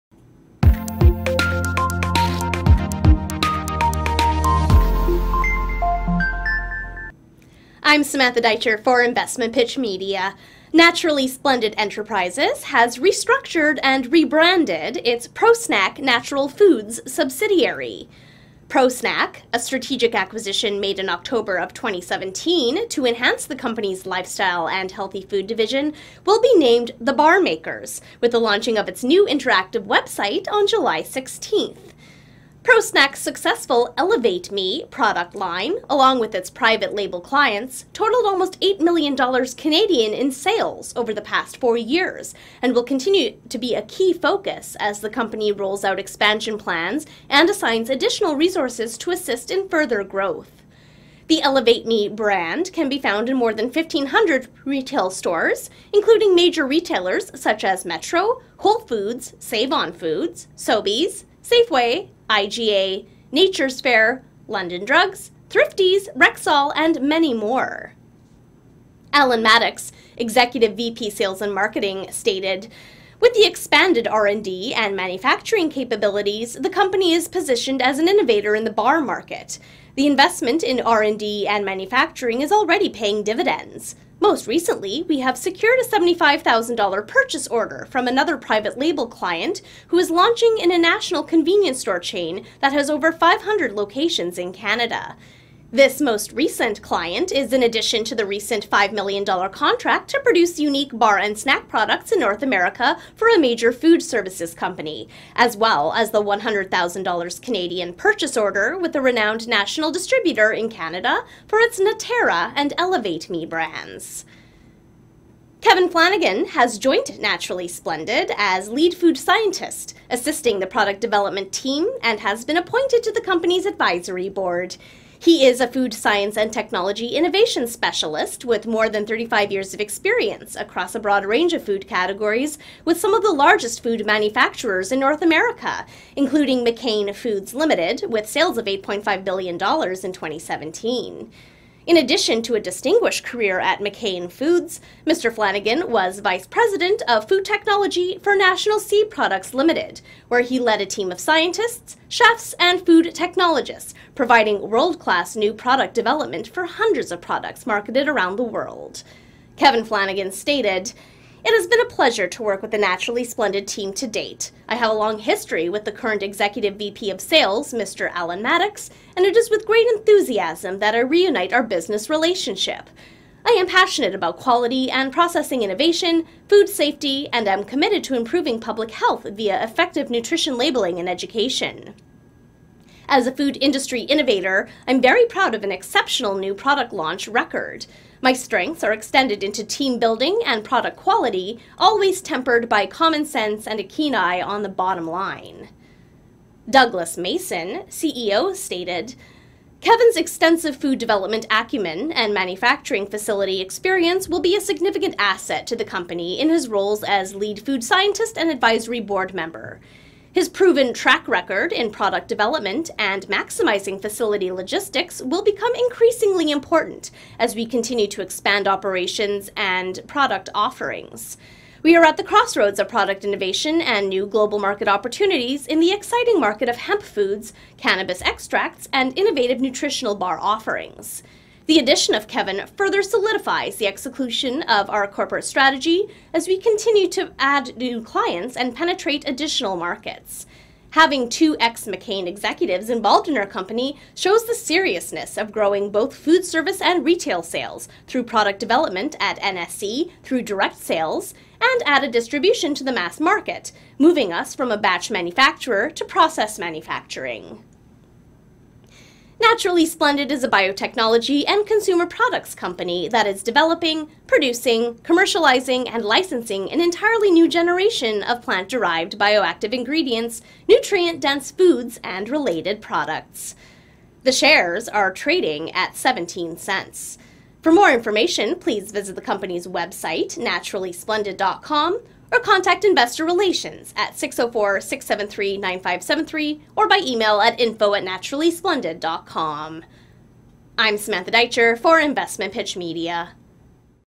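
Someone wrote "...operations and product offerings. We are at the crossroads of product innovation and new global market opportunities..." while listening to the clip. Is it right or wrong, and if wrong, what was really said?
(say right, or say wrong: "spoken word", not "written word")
right.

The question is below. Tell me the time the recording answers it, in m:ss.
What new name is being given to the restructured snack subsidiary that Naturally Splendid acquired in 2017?
0:27.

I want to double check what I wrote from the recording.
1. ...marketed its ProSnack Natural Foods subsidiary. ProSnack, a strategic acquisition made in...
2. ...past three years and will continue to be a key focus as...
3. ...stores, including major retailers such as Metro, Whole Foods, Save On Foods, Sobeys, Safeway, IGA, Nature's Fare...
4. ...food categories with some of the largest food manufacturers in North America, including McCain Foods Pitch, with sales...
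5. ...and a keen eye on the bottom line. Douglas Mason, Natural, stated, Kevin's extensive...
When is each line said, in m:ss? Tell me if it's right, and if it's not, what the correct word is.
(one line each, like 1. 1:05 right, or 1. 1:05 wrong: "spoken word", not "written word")
1. 0:14 wrong: "rebranded", not "marketed"
2. 0:41 wrong: "four", not "three"
3. 0:55 right
4. 2:11 wrong: "Limited", not "Pitch"
5. 3:13 wrong: "CEO", not "Natural".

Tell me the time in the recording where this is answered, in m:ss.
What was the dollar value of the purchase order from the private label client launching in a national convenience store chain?
1:25.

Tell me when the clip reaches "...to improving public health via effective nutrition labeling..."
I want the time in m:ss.
2:58.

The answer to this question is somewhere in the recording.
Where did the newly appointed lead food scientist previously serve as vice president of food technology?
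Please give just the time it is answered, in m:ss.
2:28.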